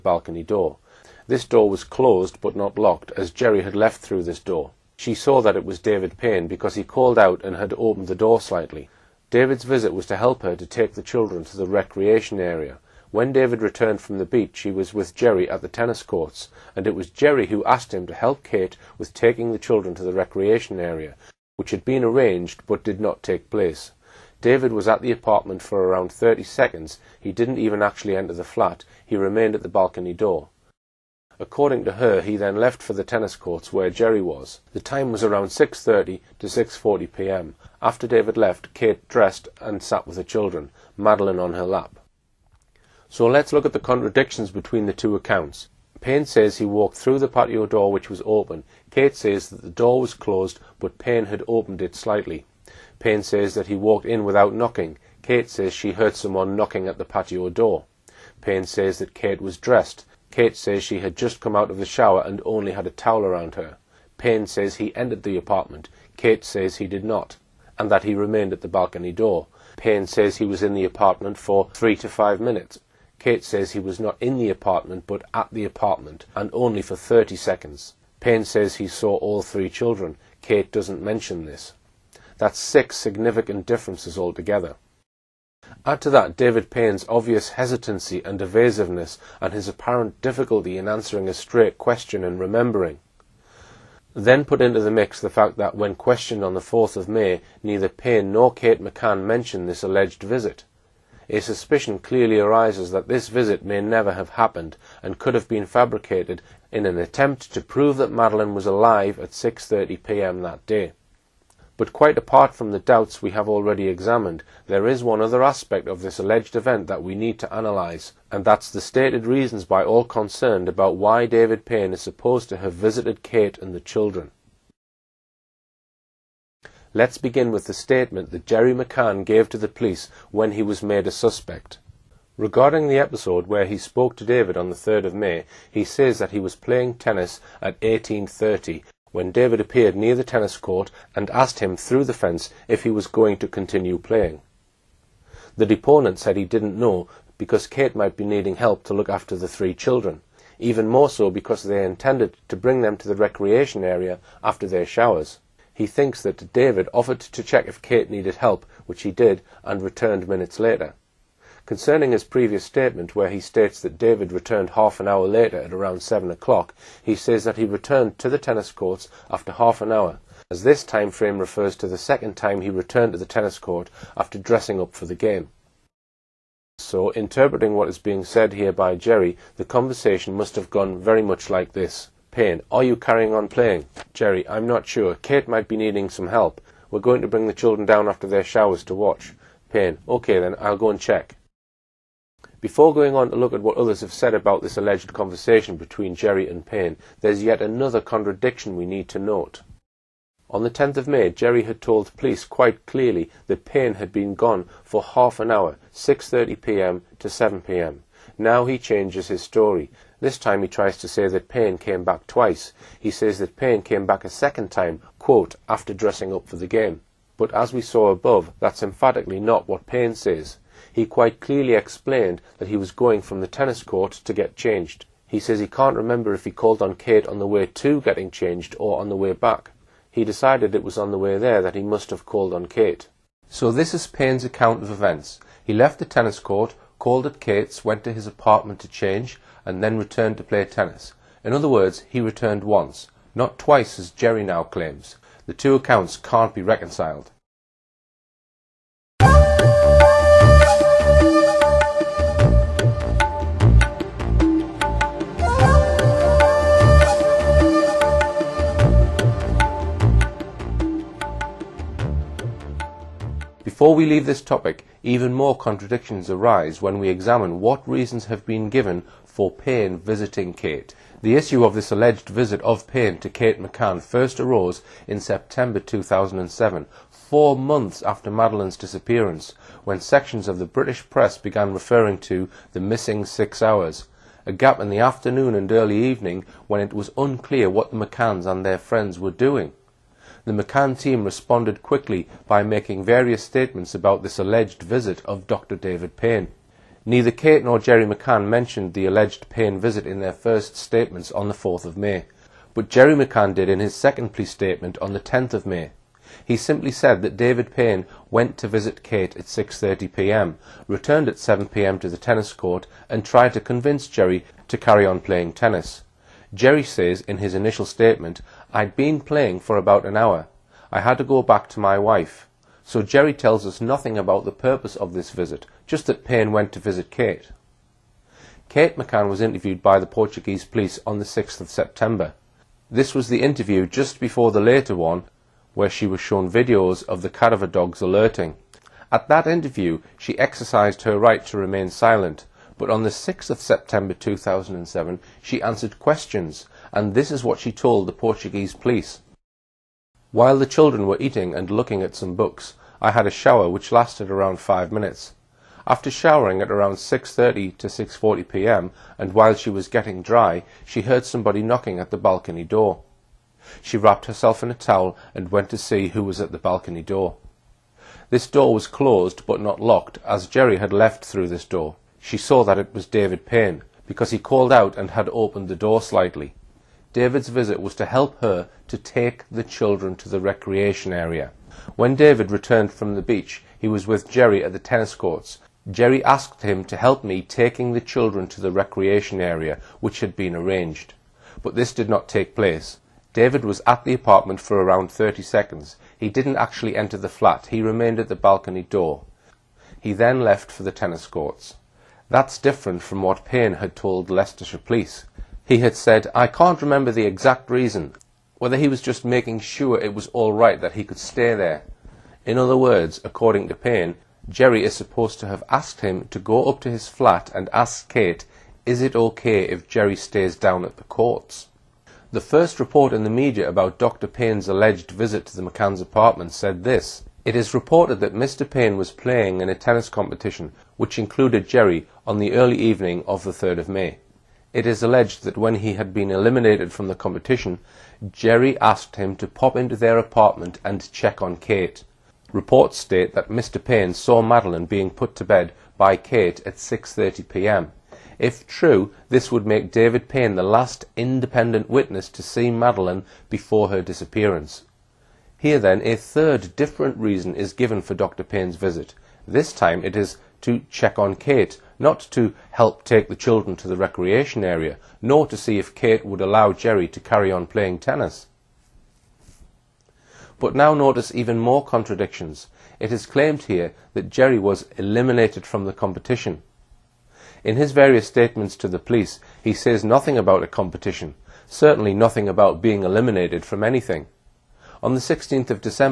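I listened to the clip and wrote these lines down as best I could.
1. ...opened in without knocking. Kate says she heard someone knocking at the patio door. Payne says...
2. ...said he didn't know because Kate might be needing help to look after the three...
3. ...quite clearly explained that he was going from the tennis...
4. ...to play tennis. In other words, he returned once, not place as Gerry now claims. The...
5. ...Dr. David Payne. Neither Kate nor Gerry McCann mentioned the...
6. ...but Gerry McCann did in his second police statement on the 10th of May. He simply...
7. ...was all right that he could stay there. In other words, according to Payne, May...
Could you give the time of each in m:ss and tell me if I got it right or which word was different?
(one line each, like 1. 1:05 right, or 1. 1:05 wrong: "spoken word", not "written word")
1. 0:53 wrong: "walked", not "opened"
2. 2:26 right
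3. 3:41 right
4. 4:00 wrong: "twice", not "place"
5. 4:55 right
6. 5:02 right
7. 6:50 wrong: "Gerry", not "May".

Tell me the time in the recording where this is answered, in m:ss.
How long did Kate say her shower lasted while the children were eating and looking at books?
5:54.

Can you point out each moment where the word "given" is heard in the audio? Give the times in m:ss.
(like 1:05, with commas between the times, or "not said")
4:28, 7:37.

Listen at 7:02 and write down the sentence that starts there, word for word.
The first report in the media about Dr.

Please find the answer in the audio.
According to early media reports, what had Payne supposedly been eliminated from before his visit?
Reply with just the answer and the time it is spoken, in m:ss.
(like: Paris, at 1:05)
a competition, at 7:09.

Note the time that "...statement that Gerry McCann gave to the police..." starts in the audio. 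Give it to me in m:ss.
2:07.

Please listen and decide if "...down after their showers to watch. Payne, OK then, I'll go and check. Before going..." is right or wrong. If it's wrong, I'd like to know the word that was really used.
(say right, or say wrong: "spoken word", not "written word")
right.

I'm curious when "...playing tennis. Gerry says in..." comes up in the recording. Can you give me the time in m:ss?
5:15.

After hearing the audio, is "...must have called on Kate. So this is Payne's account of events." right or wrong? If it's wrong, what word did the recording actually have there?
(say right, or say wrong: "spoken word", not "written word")
right.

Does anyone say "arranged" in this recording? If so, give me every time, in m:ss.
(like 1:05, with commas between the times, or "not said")
0:22, 6:30.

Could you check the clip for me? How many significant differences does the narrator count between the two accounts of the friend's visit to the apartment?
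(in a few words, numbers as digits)
6.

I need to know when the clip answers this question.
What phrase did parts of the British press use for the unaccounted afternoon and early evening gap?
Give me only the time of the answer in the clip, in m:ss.
4:42.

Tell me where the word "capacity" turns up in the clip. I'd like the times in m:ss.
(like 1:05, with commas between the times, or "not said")
not said.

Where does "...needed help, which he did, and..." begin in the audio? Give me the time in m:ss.
2:38.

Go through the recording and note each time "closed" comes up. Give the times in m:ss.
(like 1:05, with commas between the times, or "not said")
0:01, 0:50, 6:08.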